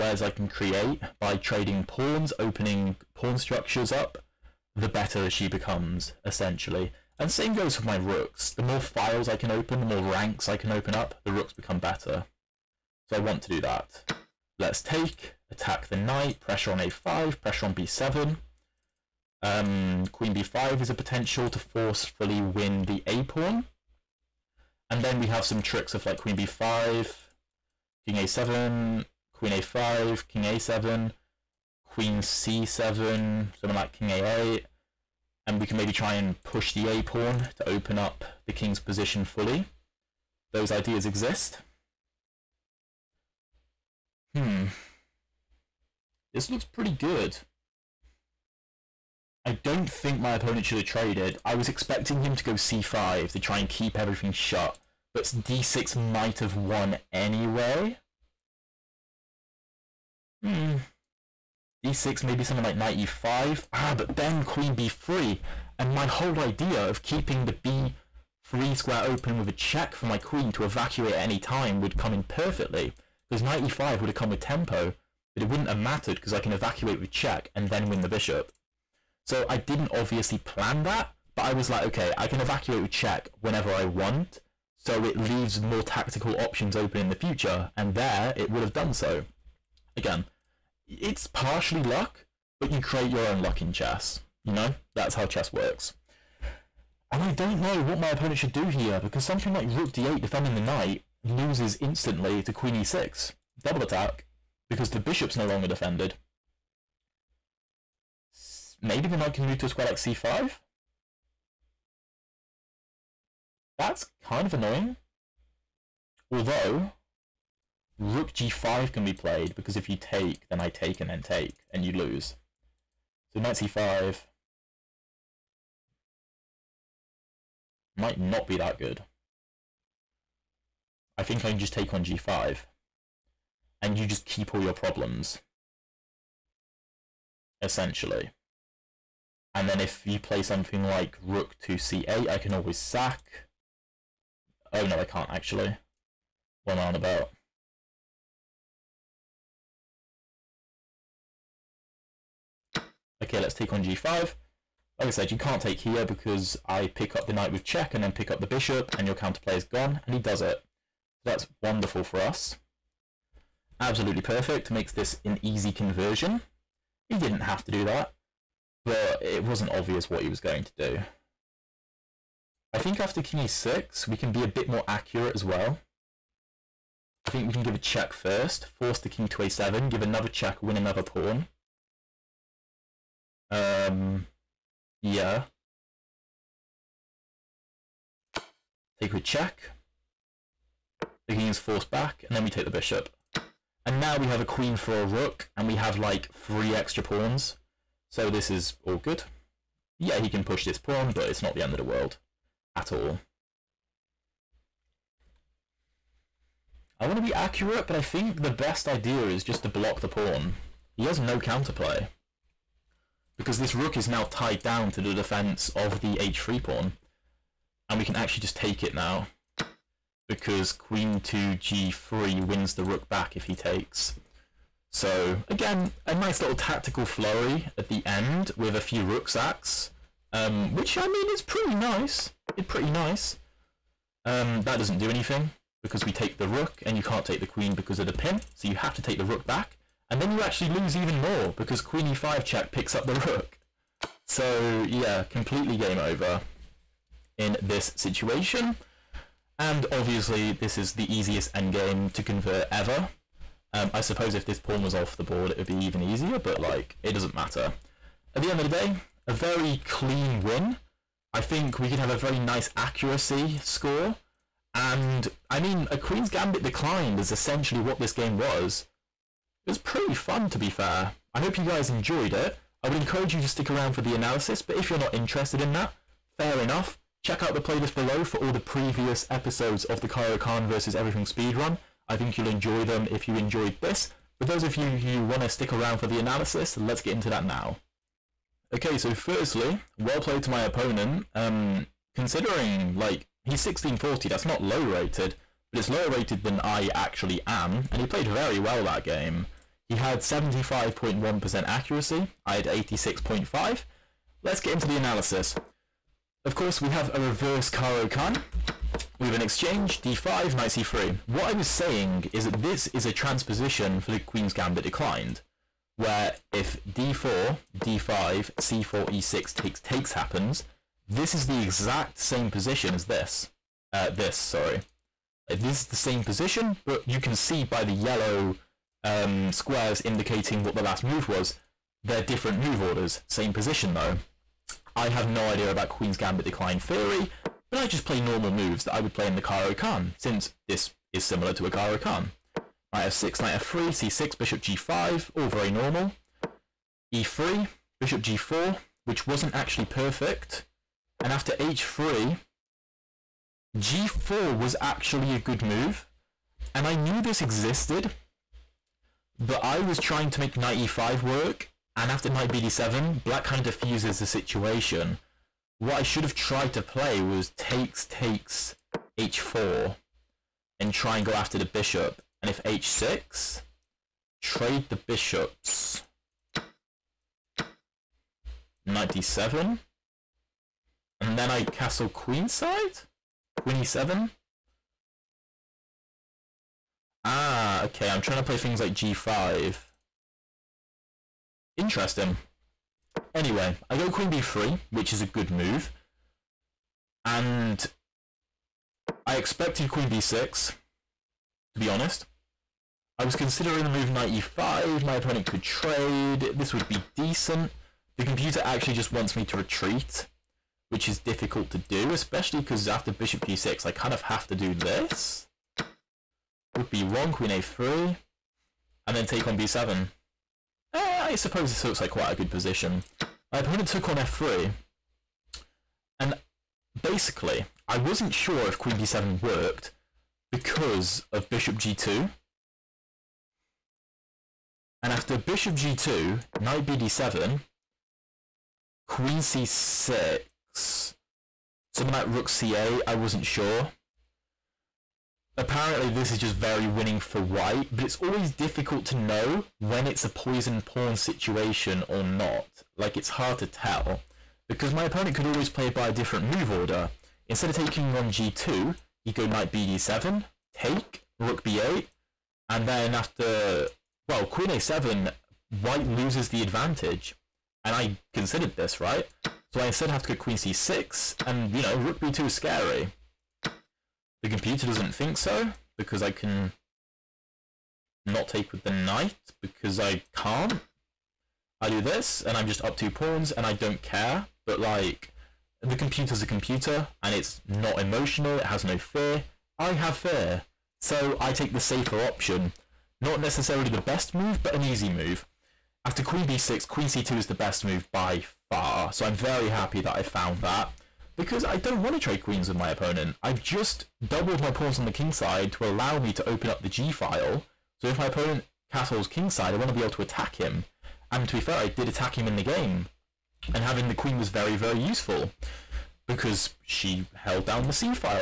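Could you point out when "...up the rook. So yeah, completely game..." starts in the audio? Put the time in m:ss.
4:02.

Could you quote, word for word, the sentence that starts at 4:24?
And I mean, a Queen's Gambit Declined is essentially what this game was.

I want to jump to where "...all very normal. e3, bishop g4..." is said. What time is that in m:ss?
5:45.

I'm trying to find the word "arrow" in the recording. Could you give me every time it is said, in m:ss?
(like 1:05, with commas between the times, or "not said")
not said.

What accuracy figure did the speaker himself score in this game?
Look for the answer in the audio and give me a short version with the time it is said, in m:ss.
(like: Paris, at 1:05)
86.5, at 5:02.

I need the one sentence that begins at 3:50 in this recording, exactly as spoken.
Um, which, I mean, is pretty nice probably pretty nice.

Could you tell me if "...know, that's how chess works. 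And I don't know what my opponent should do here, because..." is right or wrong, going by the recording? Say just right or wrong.
right.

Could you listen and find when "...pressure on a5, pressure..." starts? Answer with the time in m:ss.
0:16.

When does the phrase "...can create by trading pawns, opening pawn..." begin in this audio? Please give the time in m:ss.
0:00.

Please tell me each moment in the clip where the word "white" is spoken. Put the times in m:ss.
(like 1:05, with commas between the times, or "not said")
7:27, 7:45.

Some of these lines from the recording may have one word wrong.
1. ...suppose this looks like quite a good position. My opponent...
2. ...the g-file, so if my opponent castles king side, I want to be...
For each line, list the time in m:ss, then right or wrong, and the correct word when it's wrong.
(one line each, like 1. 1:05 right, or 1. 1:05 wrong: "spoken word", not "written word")
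1. 7:01 right
2. 8:26 right.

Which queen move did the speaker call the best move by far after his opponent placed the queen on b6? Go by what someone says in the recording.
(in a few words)
queen c2.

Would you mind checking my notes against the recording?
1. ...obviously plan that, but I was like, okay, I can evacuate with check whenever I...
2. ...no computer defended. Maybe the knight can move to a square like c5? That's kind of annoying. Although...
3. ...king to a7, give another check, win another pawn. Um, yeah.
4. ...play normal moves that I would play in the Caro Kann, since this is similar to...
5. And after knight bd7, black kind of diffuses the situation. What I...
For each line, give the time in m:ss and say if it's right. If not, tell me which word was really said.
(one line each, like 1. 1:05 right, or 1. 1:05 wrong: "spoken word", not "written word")
1. 1:19 right
2. 1:45 wrong: "longer", not "computer"
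3. 2:59 right
4. 5:38 right
5. 6:01 right.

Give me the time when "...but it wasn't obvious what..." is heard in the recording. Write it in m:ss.
2:48.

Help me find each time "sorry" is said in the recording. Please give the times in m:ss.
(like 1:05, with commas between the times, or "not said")
5:24.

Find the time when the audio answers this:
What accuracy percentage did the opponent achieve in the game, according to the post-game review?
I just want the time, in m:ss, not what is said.
5:00.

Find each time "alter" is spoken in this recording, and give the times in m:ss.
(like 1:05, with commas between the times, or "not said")
not said.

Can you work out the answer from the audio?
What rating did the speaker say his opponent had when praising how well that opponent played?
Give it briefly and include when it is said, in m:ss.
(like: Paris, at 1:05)
1640, at 4:53.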